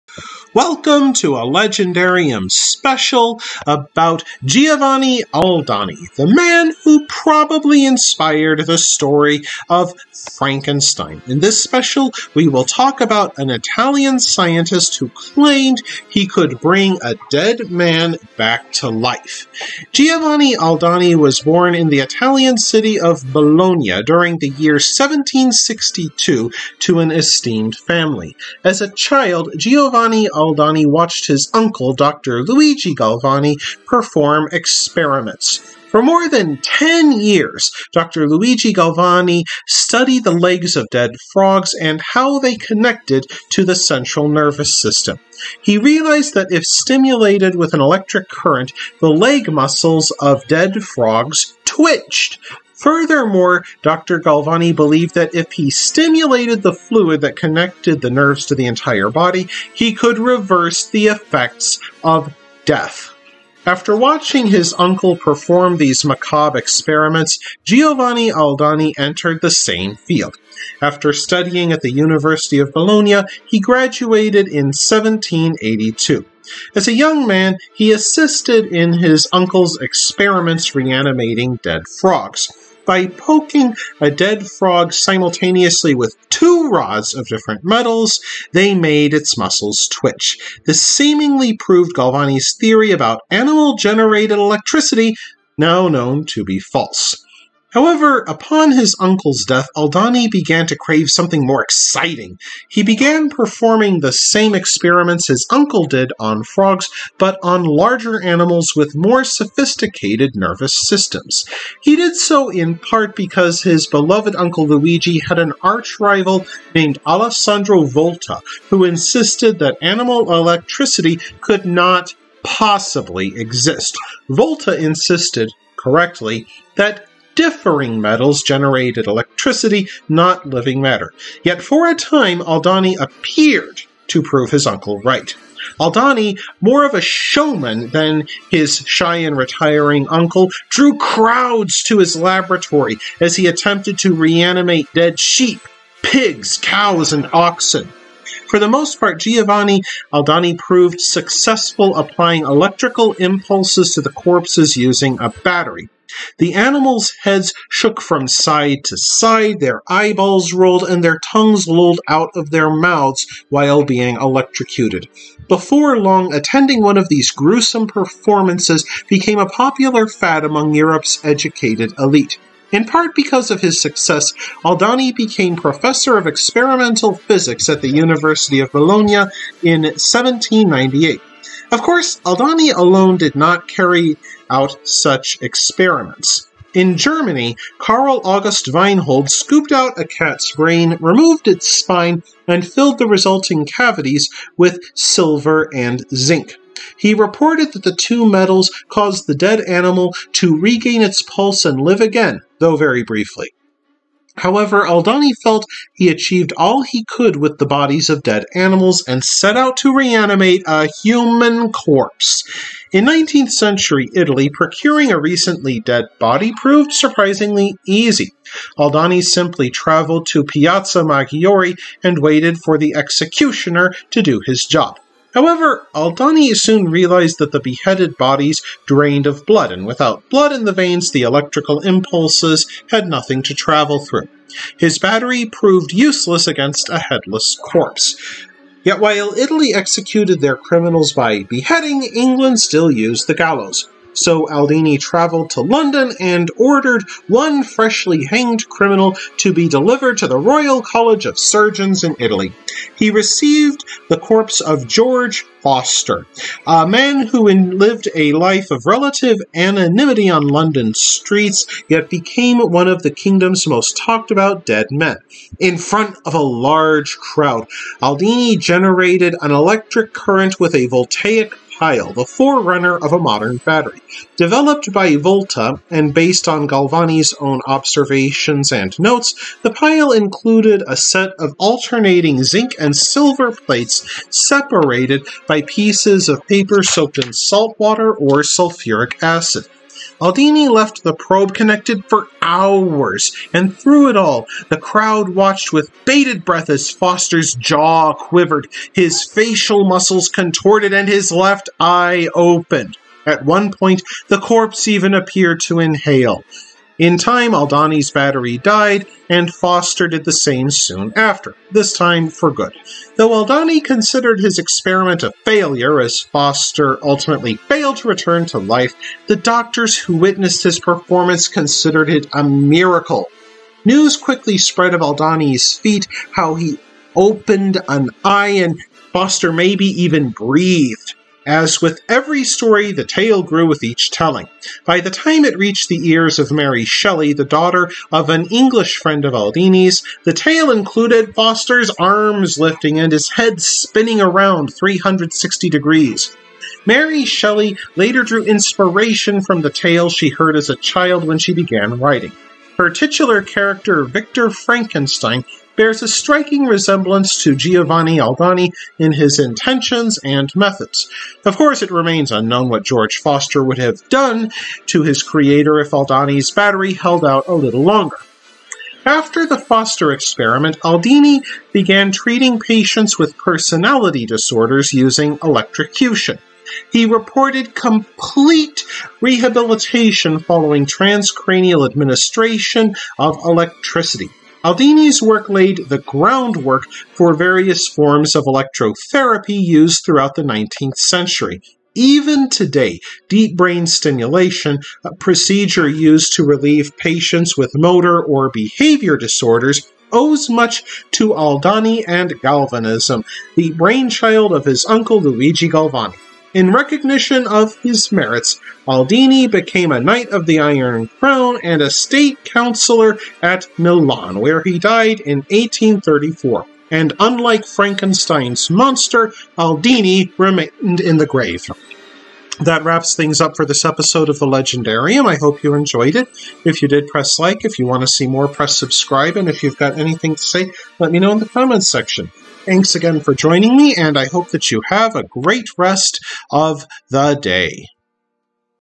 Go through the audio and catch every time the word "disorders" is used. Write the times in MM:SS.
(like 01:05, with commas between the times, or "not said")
06:14, 06:39.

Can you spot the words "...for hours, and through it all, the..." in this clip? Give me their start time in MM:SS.
04:52.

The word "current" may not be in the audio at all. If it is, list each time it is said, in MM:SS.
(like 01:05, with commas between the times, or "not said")
00:48, 04:30.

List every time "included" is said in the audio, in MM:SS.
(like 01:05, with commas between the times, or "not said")
04:40, 05:40.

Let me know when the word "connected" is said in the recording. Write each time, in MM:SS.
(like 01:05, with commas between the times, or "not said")
00:42, 00:57, 04:51.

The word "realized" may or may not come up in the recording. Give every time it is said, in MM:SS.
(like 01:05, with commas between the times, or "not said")
00:45, 03:46.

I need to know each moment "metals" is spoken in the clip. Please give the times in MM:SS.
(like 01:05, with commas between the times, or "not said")
01:27, 02:08, 03:18.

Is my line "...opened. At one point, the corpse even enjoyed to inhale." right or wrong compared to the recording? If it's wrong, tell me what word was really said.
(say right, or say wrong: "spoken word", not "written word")
wrong: "appeared", not "enjoyed".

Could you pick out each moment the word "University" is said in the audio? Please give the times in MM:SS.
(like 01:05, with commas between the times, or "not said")
01:11, 02:57.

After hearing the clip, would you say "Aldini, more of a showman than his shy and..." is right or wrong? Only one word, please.
right.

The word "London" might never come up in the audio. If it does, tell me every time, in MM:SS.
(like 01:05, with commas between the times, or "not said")
04:05, 04:20.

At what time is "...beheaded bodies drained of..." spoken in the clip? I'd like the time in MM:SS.
03:47.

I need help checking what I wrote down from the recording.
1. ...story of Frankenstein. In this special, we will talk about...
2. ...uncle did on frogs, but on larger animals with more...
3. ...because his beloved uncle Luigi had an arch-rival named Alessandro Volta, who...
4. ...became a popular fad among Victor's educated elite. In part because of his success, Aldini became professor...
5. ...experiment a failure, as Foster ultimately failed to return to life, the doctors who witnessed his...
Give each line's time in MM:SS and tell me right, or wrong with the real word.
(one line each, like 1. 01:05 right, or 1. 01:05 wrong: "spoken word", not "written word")
1. 00:08 right
2. 01:45 right
3. 01:53 right
4. 02:49 wrong: "Europe", not "Victor"
5. 05:14 right.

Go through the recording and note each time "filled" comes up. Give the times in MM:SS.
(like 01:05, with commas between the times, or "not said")
03:12.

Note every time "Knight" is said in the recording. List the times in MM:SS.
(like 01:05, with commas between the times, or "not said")
06:50.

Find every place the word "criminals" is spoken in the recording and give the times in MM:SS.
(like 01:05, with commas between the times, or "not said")
04:00, 04:08.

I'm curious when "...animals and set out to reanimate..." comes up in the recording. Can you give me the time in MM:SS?
03:28.